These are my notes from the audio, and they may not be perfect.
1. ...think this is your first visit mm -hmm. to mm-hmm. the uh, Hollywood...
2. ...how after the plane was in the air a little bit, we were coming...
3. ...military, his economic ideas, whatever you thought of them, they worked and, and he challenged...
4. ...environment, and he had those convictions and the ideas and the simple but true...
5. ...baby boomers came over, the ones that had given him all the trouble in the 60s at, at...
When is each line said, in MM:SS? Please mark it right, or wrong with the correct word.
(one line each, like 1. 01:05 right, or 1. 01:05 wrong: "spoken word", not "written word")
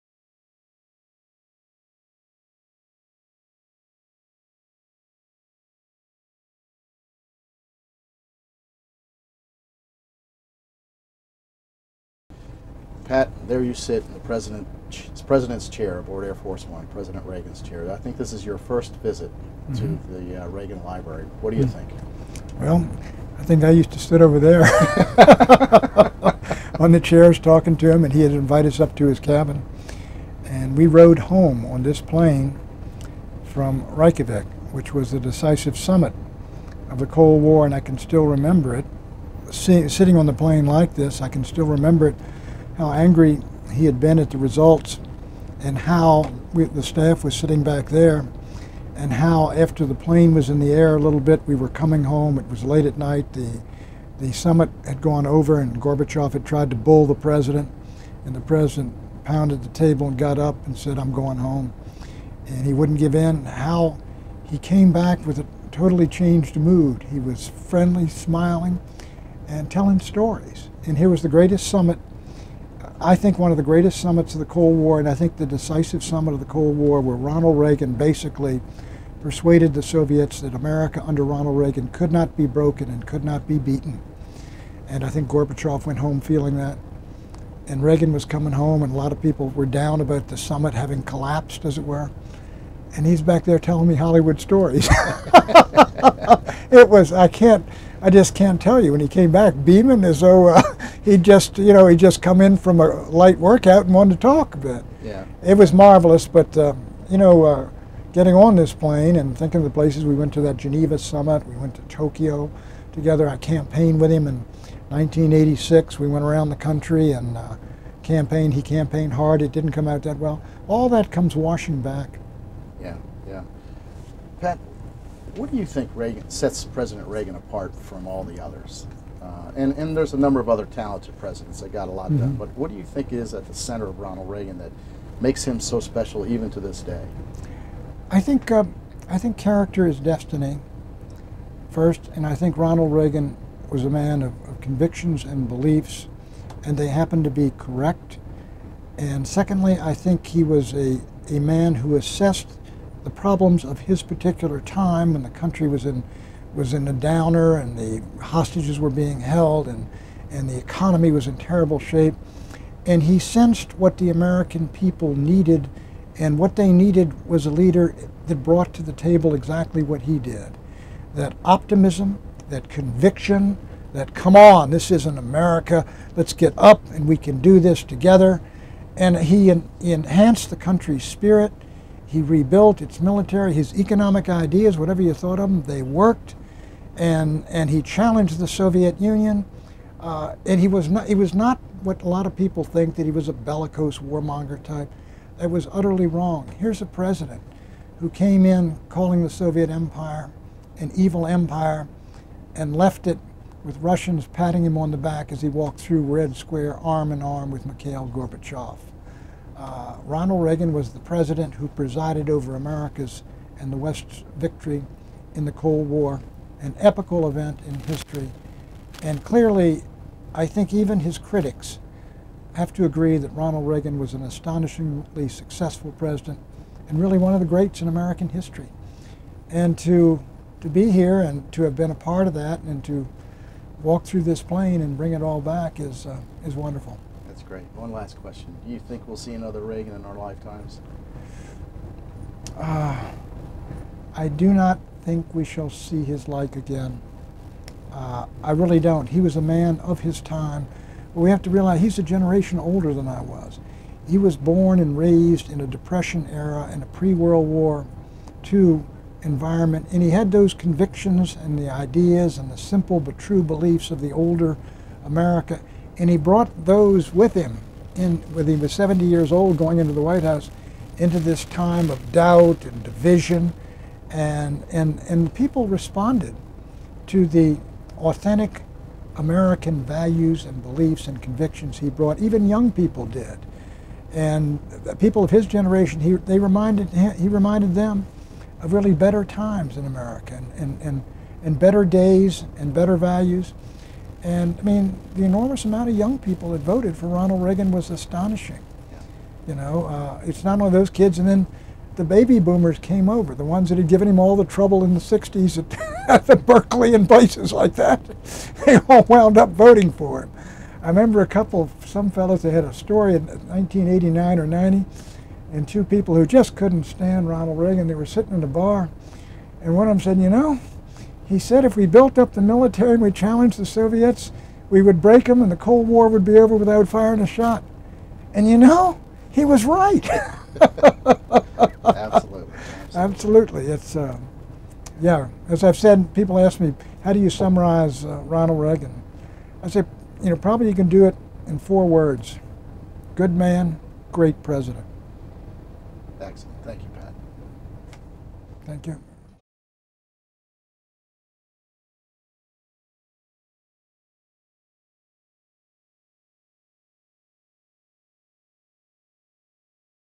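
1. 00:17 wrong: "Reagan", not "Hollywood"
2. 00:49 right
3. 03:03 right
4. 04:19 right
5. 05:02 right.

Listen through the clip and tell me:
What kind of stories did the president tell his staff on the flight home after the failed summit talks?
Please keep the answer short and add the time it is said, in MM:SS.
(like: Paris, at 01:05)
Hollywood stories, at 01:33.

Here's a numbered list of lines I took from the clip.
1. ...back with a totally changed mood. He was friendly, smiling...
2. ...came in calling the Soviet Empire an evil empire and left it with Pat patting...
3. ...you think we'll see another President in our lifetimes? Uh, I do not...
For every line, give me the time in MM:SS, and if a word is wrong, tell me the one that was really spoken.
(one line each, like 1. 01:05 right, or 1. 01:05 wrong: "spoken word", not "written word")
1. 01:04 right
2. 03:18 wrong: "Russians", not "Pat"
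3. 03:58 wrong: "Reagan", not "President".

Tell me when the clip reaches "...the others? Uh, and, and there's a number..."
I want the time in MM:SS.
02:08.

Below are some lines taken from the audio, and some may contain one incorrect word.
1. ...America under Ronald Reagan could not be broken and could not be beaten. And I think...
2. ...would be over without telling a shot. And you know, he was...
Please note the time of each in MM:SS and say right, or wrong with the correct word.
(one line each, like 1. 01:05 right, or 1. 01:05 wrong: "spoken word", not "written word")
1. 01:20 right
2. 05:26 wrong: "firing", not "telling".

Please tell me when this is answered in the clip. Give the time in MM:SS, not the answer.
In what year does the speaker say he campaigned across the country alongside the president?
01:54.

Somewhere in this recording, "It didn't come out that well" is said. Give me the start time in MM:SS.
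01:59.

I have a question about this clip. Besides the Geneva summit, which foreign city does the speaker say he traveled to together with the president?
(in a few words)
Tokyo.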